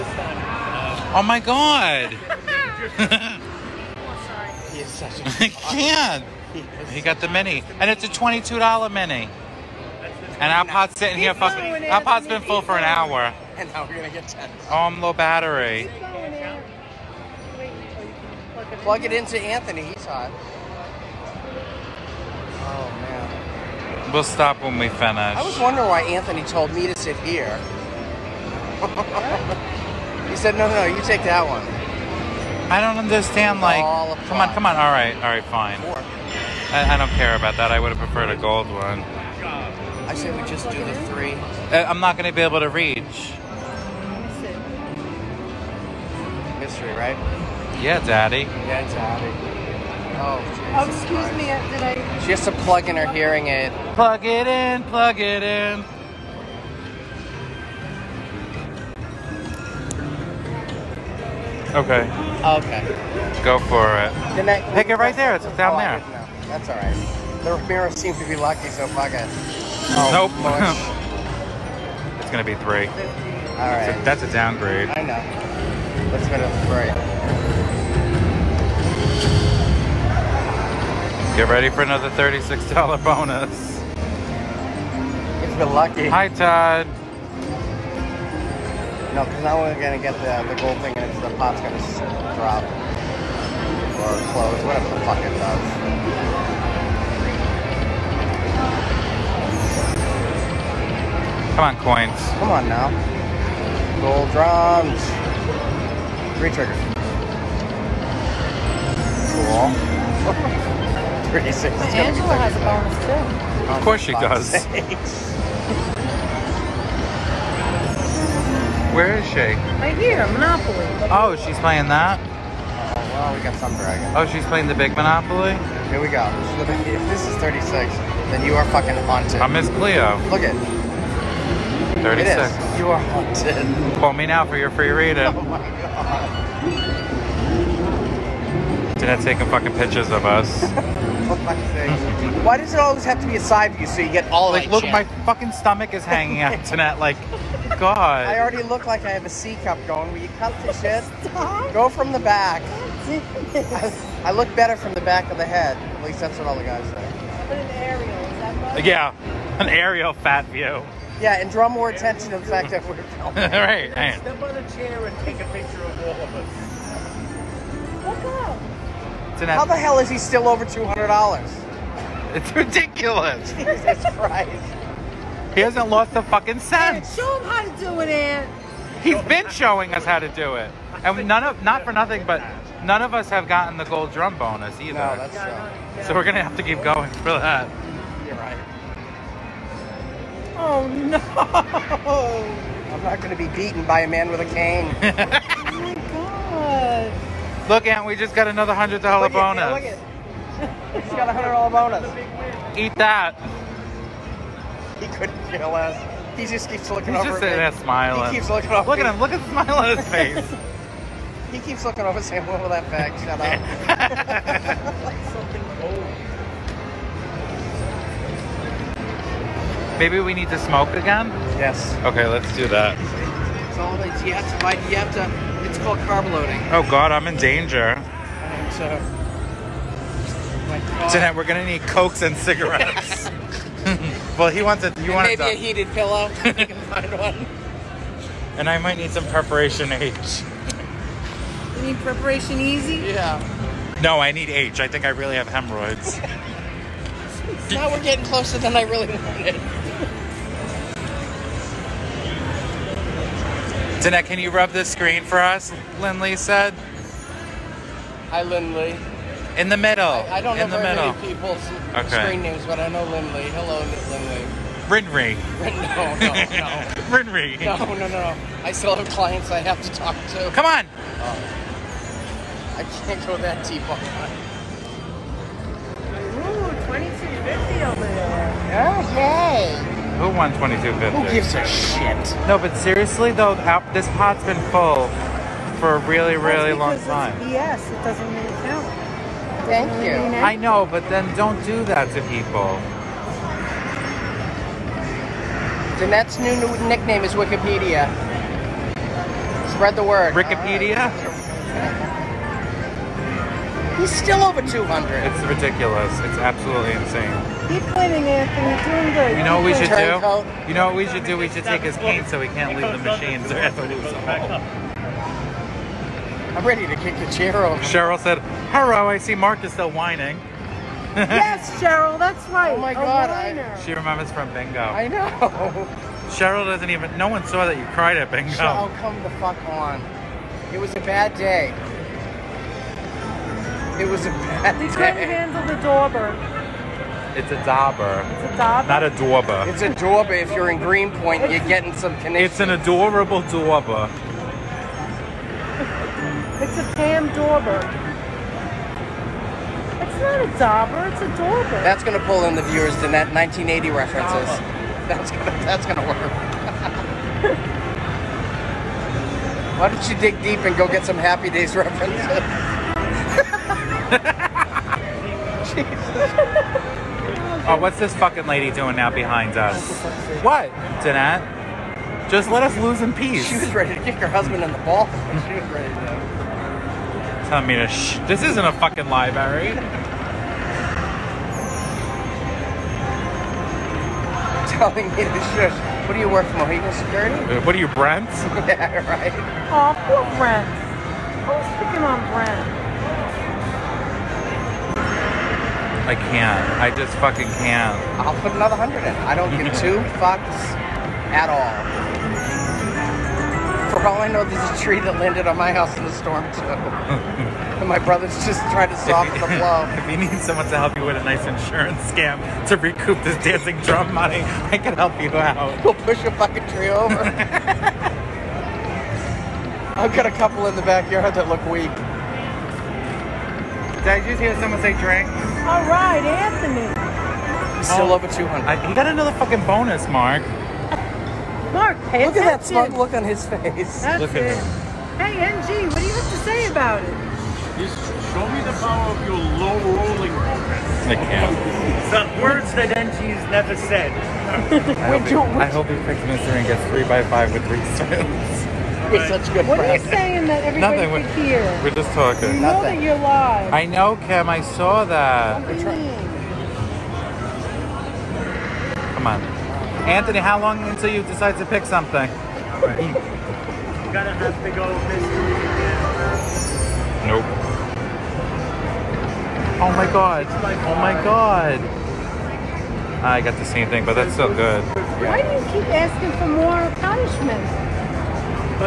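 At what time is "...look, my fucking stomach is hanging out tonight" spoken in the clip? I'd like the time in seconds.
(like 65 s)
144 s.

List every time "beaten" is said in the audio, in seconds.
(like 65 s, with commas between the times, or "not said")
193 s.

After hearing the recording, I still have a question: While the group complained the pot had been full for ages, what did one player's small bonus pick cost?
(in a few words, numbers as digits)
$22.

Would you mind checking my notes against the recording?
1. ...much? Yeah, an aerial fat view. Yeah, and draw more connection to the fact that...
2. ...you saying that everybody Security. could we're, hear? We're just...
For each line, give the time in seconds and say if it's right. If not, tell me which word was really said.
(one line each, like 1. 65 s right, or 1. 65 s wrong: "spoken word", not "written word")
1. 158 s wrong: "attention", not "connection"
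2. 450 s wrong: "Nothing", not "Security".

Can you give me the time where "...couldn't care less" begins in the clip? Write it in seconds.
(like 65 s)
205 s.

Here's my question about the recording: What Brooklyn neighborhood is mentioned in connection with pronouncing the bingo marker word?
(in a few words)
Greenpoint.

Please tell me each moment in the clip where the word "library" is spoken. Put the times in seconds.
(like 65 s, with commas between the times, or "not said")
379 s.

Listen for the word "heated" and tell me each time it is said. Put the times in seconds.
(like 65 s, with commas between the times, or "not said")
235 s.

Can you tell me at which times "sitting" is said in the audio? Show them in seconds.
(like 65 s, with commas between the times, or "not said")
10 s, 207 s.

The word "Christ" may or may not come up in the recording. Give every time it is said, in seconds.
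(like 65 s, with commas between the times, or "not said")
51 s, 174 s.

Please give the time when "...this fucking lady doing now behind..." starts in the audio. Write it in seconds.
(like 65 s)
367 s.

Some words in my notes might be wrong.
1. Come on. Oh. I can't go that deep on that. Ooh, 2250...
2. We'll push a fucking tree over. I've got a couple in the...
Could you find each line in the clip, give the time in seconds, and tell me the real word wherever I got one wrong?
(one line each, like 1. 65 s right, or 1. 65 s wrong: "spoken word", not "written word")
1. 270 s right
2. 415 s right.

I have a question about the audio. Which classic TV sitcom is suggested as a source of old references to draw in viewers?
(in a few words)
Happy Days.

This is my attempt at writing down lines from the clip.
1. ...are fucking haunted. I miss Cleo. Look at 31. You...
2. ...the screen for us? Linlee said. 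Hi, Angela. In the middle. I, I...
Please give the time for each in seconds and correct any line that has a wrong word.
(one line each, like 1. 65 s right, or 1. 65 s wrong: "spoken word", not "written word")
1. 128 s wrong: "36", not "31"
2. 254 s wrong: "Linlee", not "Angela".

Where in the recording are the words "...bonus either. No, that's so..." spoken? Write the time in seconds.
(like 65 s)
184 s.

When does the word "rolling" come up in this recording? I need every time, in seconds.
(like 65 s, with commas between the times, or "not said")
439 s.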